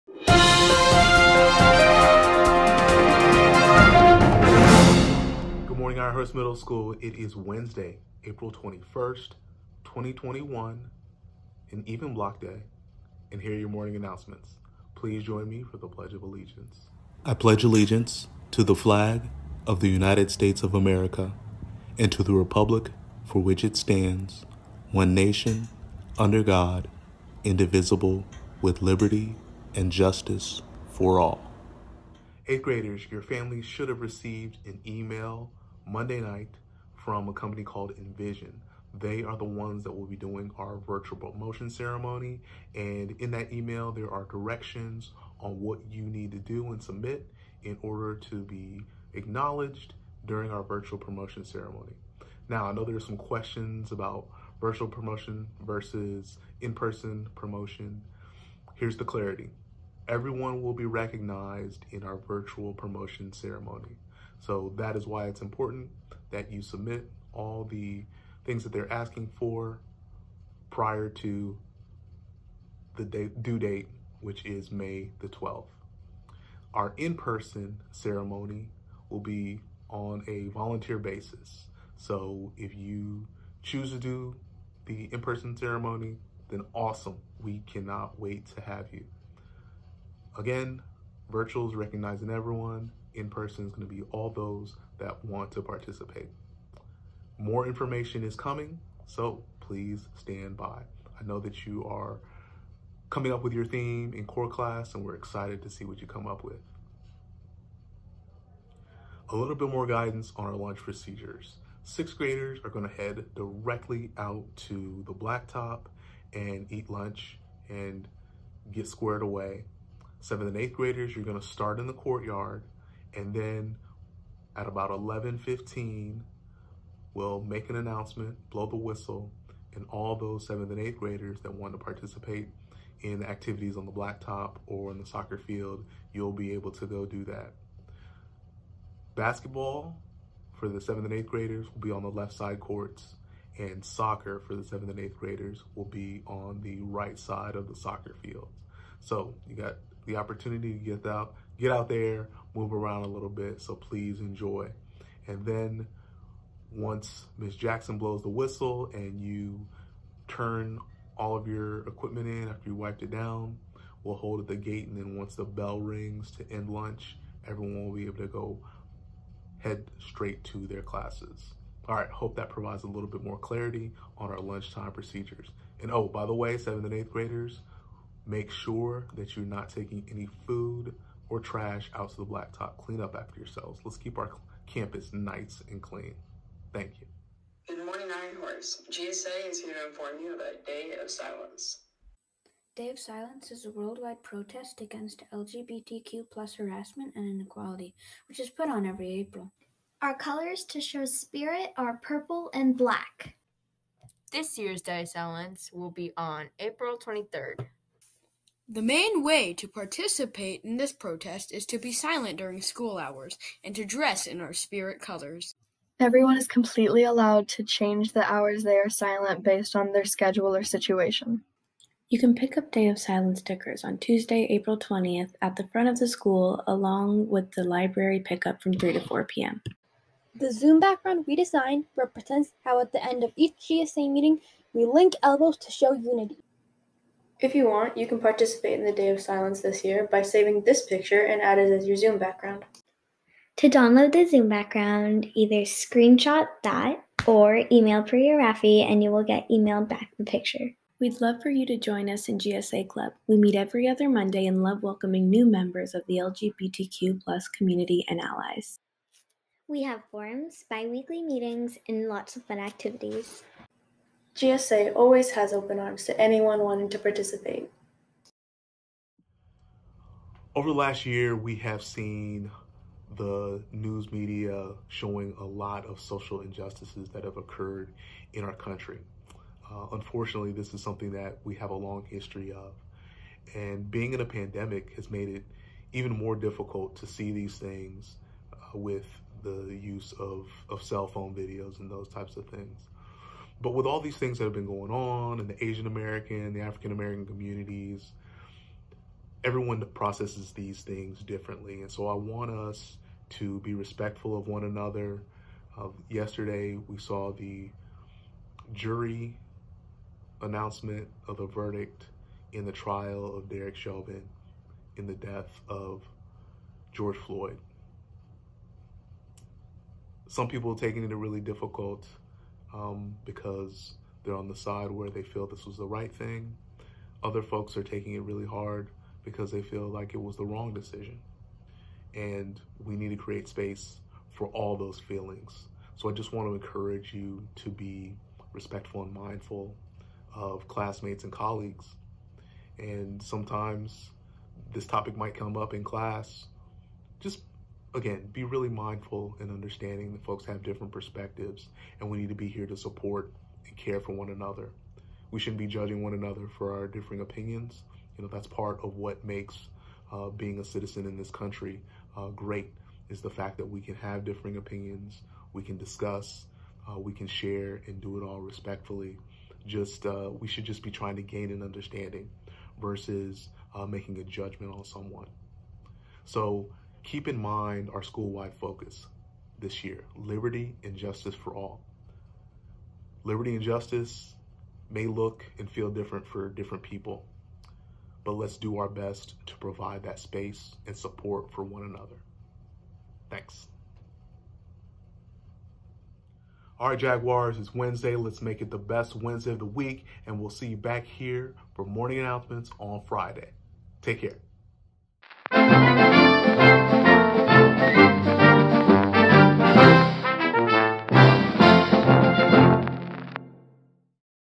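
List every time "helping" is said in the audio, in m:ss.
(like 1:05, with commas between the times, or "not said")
not said.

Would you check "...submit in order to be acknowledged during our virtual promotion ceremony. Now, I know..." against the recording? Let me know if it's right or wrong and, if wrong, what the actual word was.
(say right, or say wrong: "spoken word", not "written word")
right.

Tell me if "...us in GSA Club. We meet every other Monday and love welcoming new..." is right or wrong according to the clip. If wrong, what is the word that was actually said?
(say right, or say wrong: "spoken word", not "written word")
right.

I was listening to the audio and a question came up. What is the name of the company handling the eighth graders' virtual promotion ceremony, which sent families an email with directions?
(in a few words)
Envision.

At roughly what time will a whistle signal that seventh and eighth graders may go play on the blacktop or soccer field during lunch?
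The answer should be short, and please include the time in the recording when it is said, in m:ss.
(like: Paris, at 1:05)
11:15, at 2:04.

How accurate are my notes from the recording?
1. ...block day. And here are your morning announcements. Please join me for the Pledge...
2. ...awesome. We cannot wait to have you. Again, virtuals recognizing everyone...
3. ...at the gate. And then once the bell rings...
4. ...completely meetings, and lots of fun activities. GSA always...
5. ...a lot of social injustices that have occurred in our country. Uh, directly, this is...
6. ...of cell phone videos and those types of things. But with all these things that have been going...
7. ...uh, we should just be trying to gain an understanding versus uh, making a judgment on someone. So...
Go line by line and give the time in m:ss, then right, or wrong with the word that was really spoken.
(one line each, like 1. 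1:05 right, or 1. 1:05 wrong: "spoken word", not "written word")
1. 0:12 right
2. 1:26 right
3. 2:44 right
4. 4:20 wrong: "weekly", not "completely"
5. 4:35 wrong: "unfortunately", not "directly"
6. 4:50 right
7. 6:10 right.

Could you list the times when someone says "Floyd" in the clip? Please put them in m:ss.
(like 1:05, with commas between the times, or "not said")
5:17.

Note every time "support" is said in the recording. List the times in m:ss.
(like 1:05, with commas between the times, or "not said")
5:52, 6:30.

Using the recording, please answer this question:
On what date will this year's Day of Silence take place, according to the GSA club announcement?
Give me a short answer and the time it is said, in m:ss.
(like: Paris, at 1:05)
April 23, at 3:26.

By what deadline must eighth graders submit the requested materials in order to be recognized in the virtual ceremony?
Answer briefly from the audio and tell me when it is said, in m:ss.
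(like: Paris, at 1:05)
May 12, at 1:14.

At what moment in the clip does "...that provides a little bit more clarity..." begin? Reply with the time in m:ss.
2:52.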